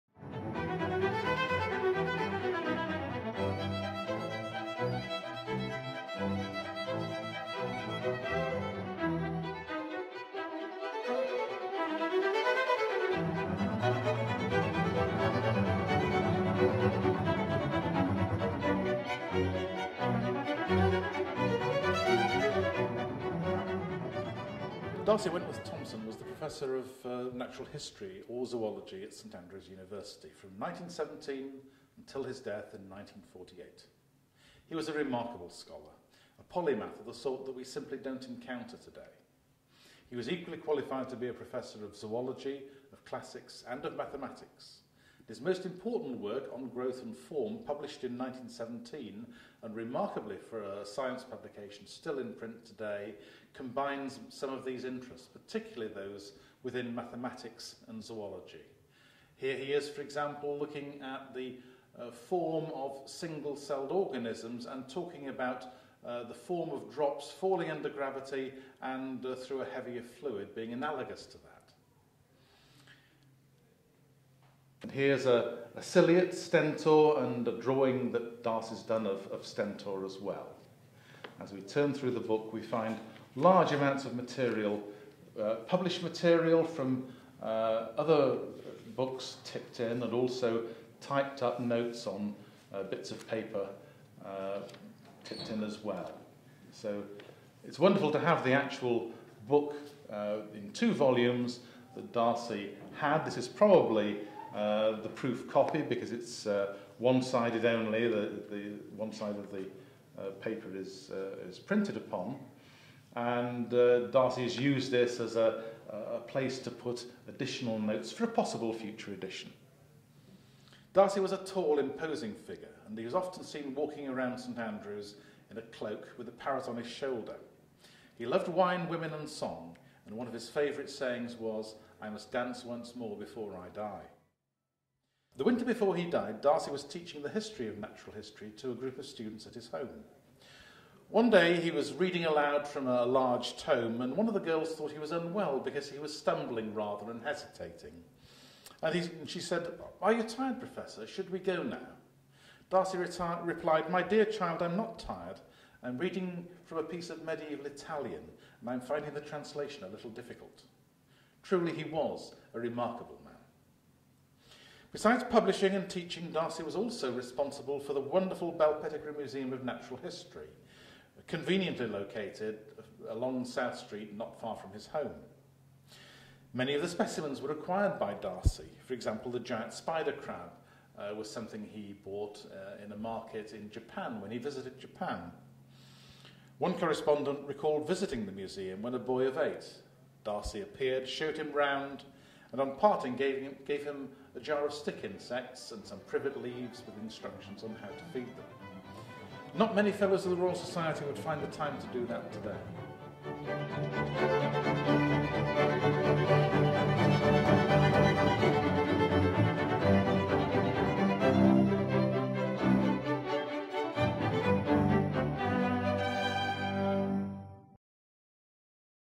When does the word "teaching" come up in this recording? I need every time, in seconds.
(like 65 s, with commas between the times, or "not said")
136 s, 165 s.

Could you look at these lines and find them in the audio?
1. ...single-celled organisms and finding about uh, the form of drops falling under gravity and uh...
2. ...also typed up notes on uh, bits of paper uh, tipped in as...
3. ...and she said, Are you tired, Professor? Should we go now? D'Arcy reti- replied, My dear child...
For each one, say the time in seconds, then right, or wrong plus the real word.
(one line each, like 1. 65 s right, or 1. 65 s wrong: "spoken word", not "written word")
1. 63 s wrong: "talking", not "finding"
2. 90 s right
3. 149 s right.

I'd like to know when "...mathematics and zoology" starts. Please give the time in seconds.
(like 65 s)
56 s.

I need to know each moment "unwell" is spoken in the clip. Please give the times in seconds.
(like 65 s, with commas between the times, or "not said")
145 s.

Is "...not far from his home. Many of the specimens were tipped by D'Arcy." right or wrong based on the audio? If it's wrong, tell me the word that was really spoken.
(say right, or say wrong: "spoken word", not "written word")
wrong: "acquired", not "tipped".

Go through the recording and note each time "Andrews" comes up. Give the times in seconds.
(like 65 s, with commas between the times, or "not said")
29 s, 124 s.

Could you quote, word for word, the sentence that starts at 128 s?
He loved wine, women, and song, and one of his favourite sayings was, I must dance once more before I die.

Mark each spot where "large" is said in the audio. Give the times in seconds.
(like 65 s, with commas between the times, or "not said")
83 s, 143 s.